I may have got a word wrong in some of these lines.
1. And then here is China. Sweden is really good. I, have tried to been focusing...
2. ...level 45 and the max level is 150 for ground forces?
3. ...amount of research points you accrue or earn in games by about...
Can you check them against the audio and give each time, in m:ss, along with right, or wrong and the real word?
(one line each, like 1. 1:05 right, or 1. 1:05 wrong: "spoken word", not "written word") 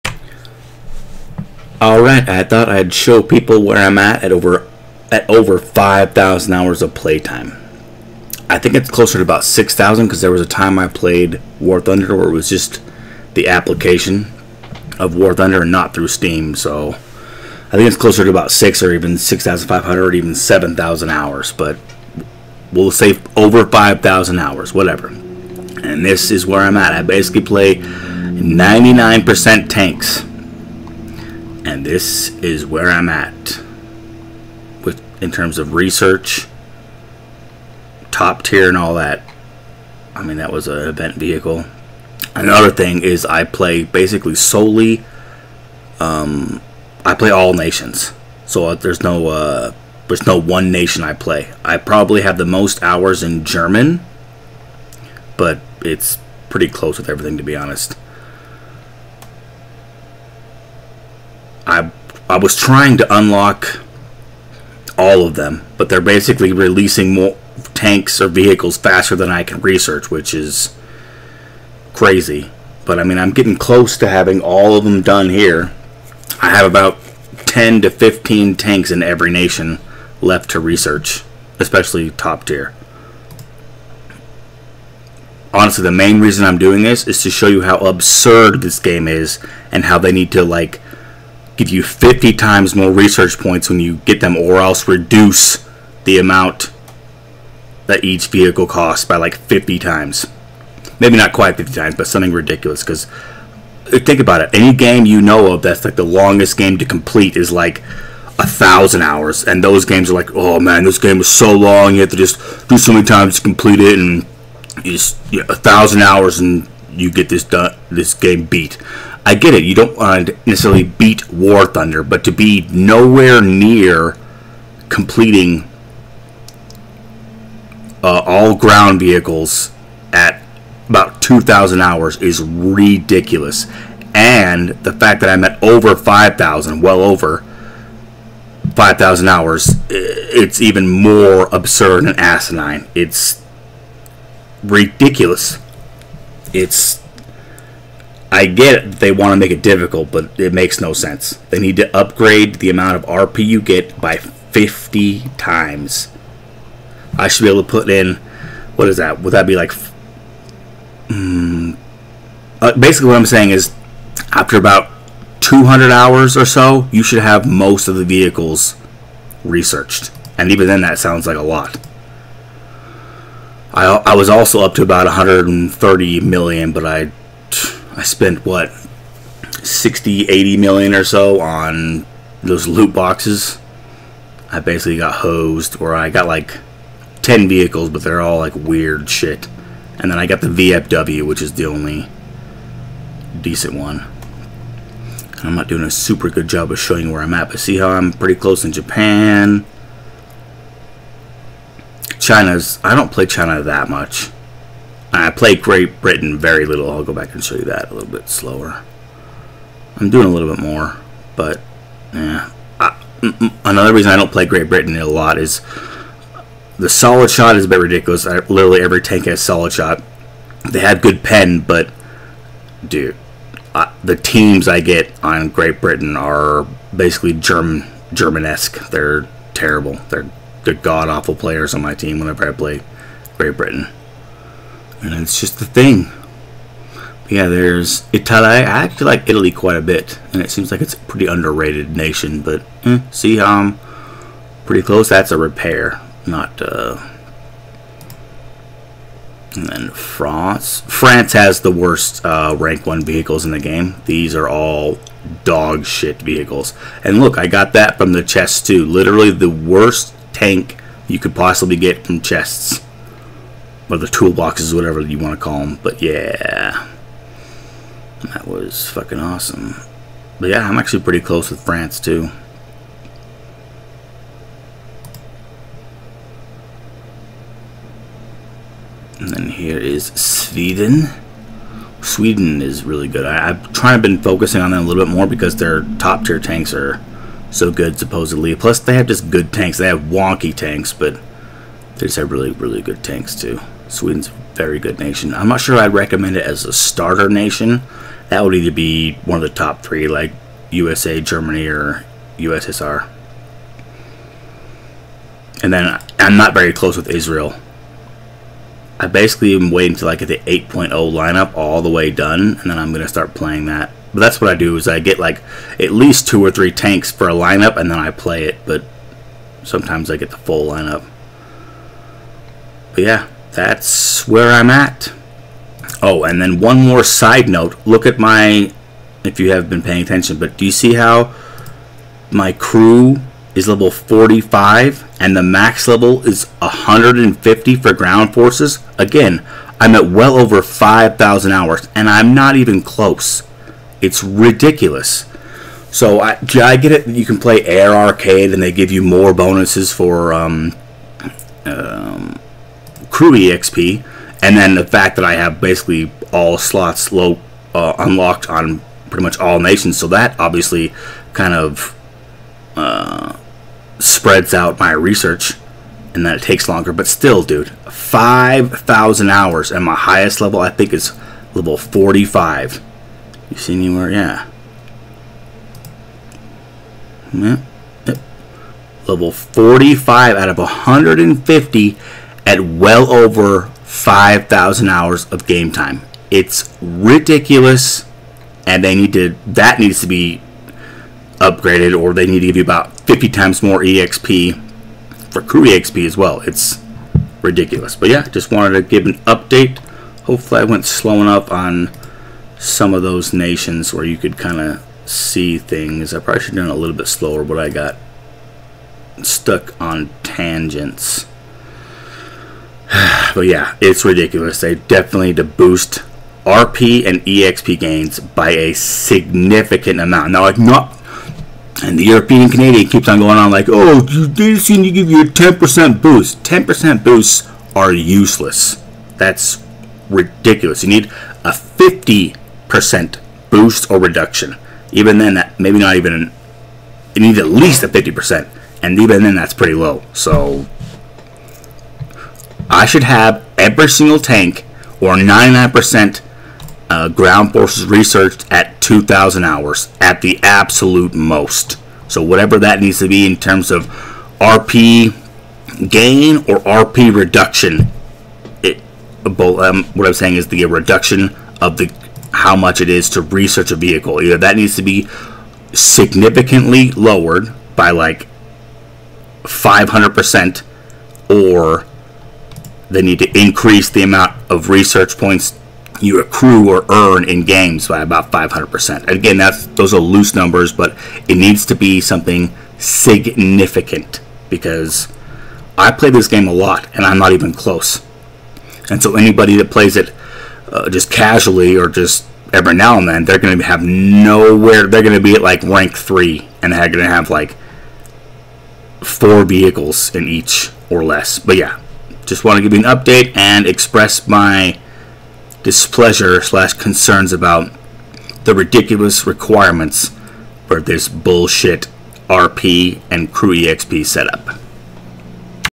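1. 4:39 wrong: "Sweden", not "China"
2. 5:33 right
3. 7:54 right.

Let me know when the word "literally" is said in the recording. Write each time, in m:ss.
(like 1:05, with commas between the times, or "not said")
3:38, 4:18.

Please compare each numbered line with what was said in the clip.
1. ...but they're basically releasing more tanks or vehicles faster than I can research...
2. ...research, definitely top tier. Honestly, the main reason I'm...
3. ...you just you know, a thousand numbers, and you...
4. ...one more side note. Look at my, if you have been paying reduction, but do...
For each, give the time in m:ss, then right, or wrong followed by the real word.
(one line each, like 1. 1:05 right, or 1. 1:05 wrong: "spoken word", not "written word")
1. 1:05 right
2. 1:20 wrong: "especially", not "definitely"
3. 1:54 wrong: "hours", not "numbers"
4. 5:26 wrong: "attention", not "reduction".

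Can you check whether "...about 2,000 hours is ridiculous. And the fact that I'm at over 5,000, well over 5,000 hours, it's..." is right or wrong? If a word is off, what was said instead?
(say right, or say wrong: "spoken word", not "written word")
right.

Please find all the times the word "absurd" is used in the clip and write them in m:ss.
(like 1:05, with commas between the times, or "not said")
1:27, 2:21.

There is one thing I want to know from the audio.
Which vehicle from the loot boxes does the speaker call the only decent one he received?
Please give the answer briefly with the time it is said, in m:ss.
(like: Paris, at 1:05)
VFW, at 3:10.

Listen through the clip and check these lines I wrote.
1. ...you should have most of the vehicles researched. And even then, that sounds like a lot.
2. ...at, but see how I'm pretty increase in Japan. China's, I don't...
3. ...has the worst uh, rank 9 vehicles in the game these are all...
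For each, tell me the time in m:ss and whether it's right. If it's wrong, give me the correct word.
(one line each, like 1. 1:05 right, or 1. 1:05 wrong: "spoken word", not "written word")
1. 2:46 right
2. 3:17 wrong: "close", not "increase"
3. 4:11 wrong: "1", not "9".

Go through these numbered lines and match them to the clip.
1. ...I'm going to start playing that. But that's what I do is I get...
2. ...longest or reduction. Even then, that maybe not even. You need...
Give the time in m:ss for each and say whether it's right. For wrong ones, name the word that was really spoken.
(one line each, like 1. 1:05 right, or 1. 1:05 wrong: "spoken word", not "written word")
1. 5:12 right
2. 7:13 wrong: "boost", not "longest".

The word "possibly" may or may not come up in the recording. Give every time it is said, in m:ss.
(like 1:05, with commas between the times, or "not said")
4:21.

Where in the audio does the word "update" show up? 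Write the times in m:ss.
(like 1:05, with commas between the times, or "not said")
6:39, 8:22.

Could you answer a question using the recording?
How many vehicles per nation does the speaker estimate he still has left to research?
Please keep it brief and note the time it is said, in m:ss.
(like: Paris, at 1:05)
10 to 15, at 1:17.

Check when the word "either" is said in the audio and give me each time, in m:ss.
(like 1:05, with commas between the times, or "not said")
4:58, 7:44.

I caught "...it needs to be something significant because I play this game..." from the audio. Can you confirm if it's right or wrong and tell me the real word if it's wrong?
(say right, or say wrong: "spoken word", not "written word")
right.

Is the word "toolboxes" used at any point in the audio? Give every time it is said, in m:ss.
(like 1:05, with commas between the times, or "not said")
4:24.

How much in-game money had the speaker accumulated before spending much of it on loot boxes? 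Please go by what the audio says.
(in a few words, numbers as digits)
130 million.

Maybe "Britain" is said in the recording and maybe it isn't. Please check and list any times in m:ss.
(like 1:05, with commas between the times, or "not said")
3:26, 3:34, 3:45, 3:53.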